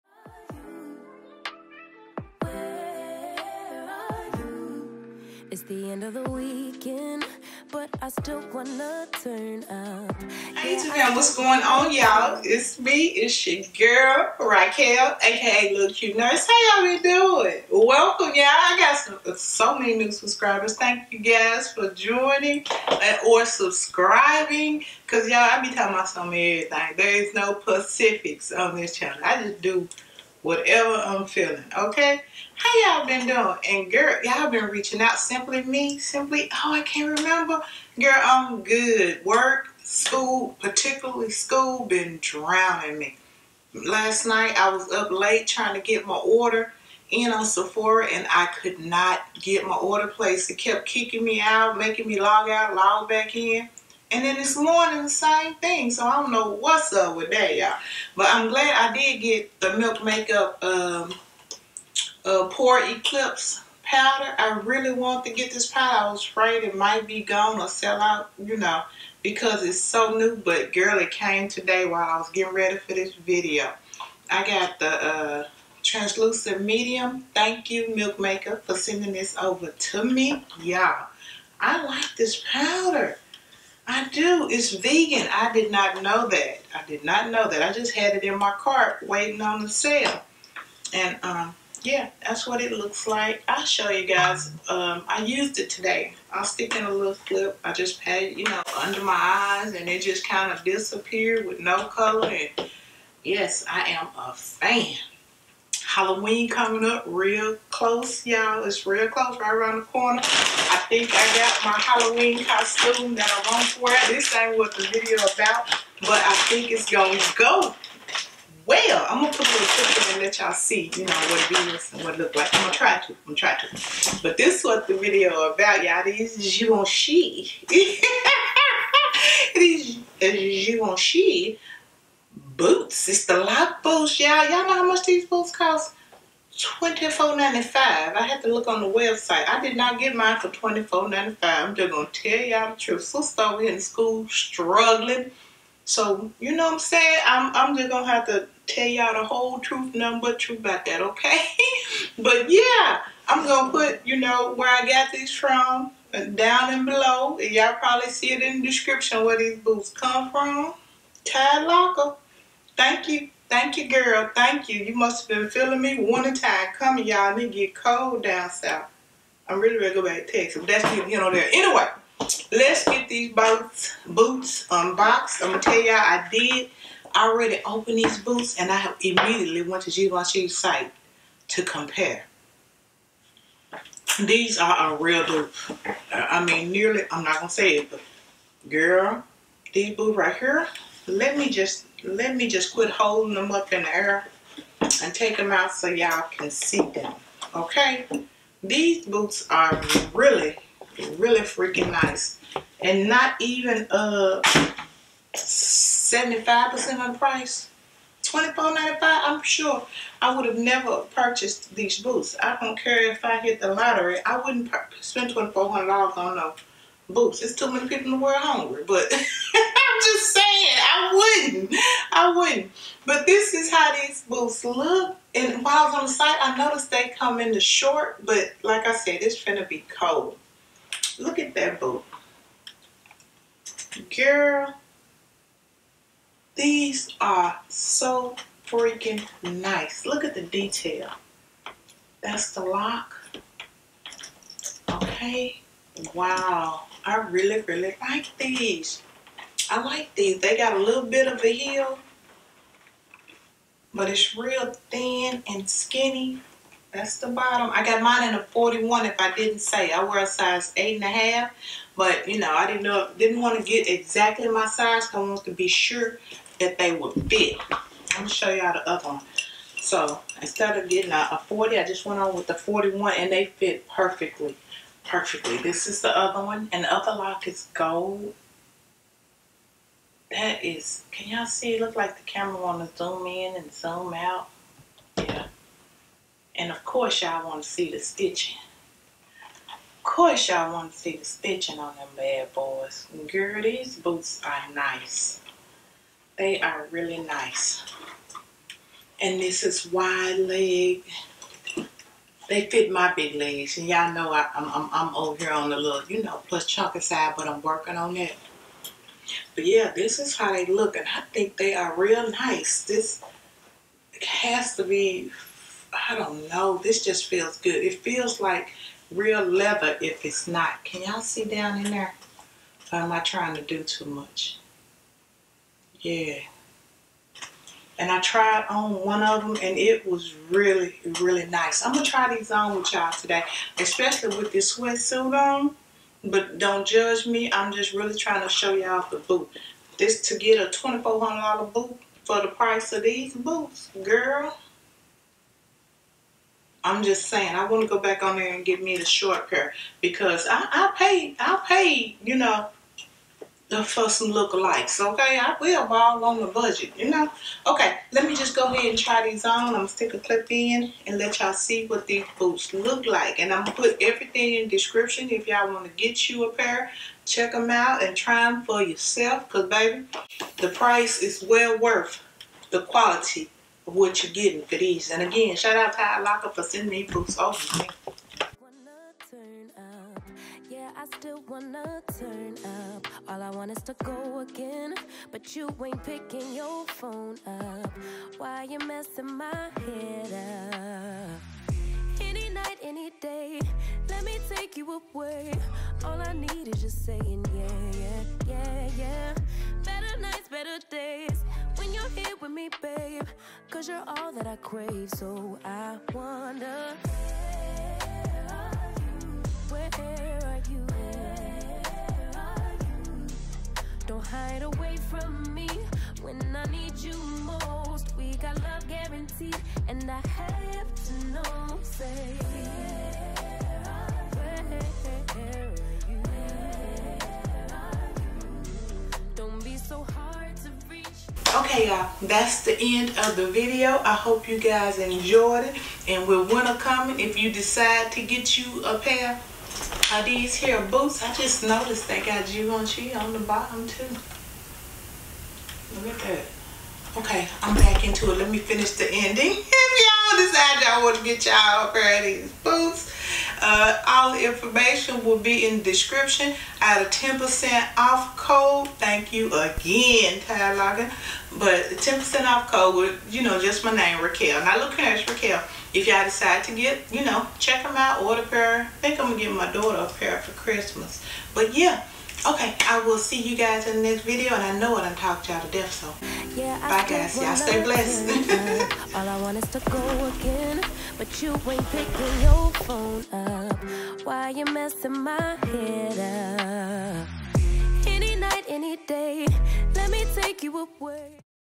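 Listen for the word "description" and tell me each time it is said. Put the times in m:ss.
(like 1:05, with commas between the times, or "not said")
2:38, 6:04, 7:35.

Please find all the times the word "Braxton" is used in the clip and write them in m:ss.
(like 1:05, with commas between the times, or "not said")
not said.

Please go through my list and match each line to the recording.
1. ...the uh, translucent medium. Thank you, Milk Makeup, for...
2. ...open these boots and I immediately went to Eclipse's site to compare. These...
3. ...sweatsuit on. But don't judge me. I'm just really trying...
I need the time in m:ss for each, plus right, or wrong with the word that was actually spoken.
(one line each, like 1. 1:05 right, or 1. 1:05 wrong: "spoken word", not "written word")
1. 1:14 right
2. 2:57 wrong: "Givenchy", not "Eclipse"
3. 5:34 right.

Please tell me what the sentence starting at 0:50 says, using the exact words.
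It kept kicking me out, making me log out, log back in.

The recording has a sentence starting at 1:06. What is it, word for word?
I was afraid it might be gone or sell out, you know, because it's so new.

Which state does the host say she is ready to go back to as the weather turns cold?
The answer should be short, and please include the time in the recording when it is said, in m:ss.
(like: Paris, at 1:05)
Texas, at 2:50.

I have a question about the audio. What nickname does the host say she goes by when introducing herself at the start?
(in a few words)
Little Cute Nurse.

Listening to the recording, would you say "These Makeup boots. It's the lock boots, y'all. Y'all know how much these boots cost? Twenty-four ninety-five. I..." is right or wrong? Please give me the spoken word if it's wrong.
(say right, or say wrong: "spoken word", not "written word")
wrong: "Givenchy", not "Makeup".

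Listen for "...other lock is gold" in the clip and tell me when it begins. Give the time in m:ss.
4:36.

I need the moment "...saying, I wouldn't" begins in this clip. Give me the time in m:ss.
3:40.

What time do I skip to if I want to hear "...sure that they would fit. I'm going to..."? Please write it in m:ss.
4:25.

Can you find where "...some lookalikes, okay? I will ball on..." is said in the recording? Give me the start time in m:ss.
5:54.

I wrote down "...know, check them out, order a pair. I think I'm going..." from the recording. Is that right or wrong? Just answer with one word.
right.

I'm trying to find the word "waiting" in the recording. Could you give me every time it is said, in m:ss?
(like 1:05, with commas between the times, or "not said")
1:29.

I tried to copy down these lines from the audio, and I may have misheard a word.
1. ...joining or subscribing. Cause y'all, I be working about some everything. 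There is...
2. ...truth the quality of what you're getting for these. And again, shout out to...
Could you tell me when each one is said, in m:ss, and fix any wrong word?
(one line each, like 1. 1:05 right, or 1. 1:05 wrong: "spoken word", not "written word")
1. 0:21 wrong: "talking", not "working"
2. 6:11 wrong: "worth", not "truth".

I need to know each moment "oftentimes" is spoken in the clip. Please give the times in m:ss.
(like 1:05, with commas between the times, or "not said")
not said.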